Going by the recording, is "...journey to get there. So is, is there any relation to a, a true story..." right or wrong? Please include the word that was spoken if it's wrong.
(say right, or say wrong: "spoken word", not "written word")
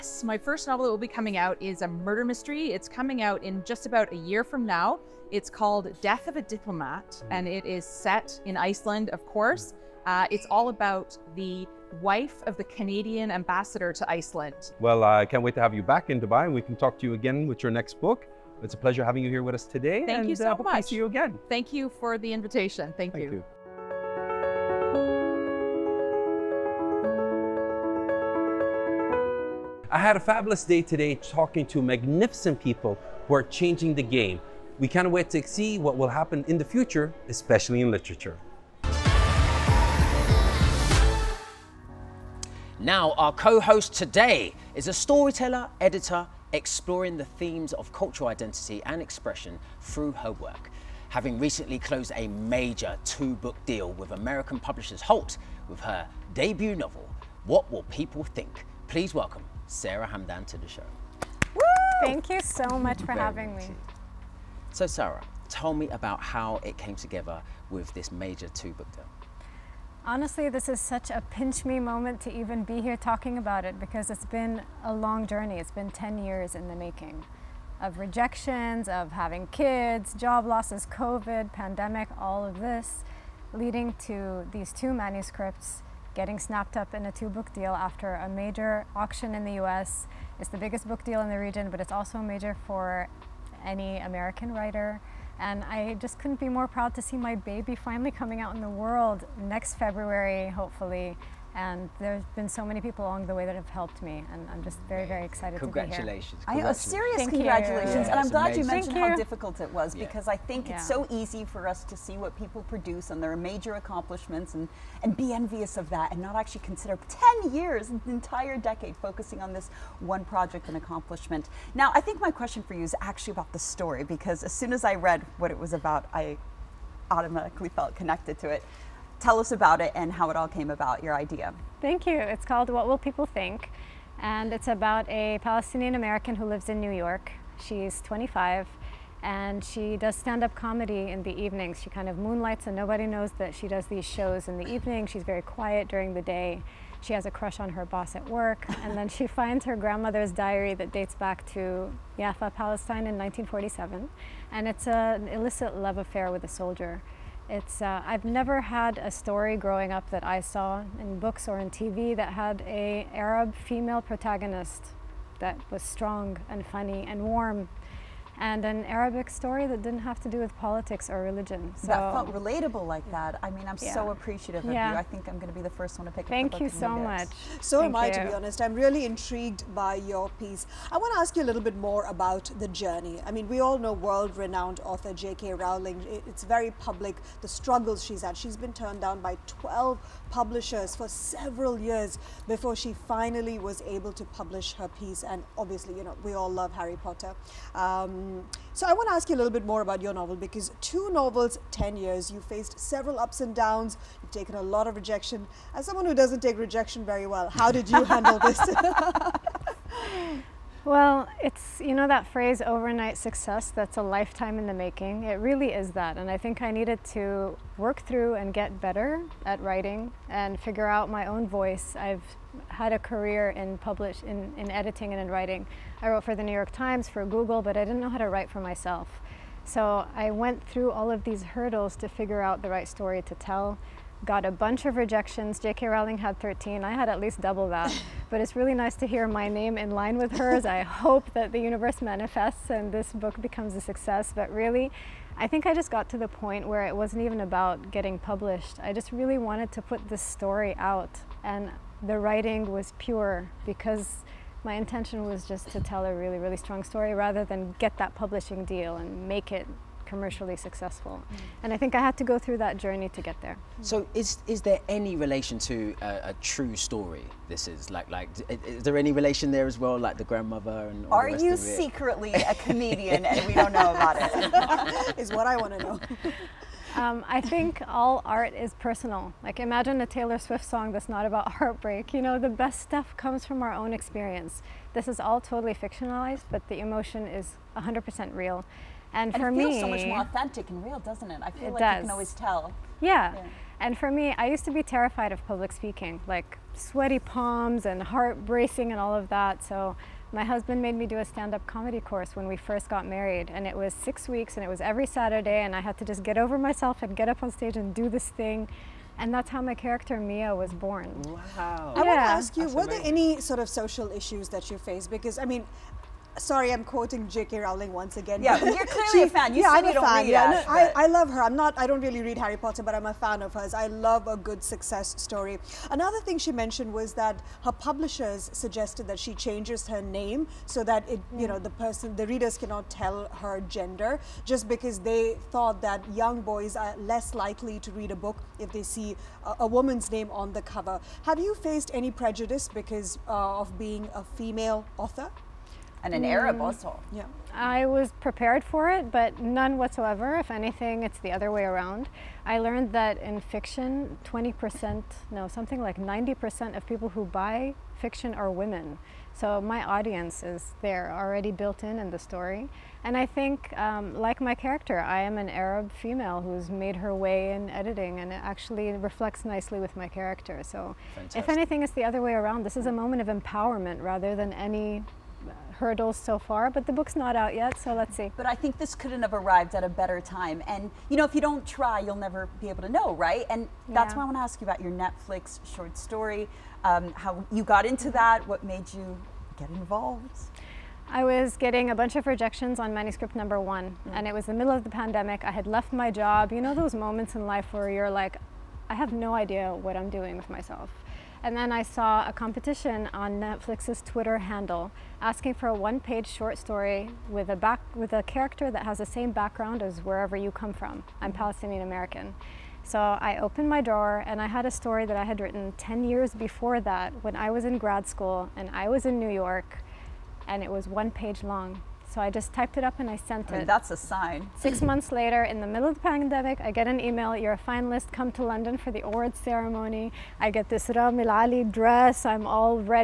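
right.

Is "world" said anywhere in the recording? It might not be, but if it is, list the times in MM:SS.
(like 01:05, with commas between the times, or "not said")
01:38, 03:03.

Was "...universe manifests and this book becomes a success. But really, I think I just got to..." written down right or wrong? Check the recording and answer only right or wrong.
right.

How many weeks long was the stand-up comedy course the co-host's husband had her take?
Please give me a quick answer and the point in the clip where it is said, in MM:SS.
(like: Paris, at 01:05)
6, at 05:03.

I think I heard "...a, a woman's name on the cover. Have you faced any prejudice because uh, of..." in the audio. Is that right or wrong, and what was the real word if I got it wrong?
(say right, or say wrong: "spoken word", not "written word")
right.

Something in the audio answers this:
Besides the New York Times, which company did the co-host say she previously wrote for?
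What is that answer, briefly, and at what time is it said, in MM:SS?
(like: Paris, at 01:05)
Google, at 03:47.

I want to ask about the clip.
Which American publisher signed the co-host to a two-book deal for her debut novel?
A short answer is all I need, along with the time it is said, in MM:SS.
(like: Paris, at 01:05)
Holt, at 00:55.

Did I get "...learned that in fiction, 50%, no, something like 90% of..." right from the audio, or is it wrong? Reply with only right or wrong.
wrong.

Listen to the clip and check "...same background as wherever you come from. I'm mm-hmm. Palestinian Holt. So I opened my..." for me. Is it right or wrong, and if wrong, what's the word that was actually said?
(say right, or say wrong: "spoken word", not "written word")
wrong: "American", not "Holt".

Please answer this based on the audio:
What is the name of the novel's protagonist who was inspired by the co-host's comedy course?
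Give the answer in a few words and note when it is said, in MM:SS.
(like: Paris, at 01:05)
Mia, at 05:10.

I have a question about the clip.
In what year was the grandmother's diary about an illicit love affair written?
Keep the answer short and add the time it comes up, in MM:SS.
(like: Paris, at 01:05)
1947, at 02:33.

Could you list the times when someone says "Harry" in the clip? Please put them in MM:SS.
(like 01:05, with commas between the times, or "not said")
03:16, 05:22.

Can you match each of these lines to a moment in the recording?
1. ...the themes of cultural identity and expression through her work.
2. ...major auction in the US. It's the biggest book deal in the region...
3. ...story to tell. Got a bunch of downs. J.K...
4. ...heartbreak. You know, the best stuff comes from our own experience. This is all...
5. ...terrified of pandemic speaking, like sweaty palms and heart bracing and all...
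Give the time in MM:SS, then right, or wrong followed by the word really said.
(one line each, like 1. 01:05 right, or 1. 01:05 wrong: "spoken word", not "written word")
1. 00:47 right
2. 01:28 right
3. 03:52 wrong: "rejections", not "downs"
4. 04:41 right
5. 04:54 wrong: "public", not "pandemic".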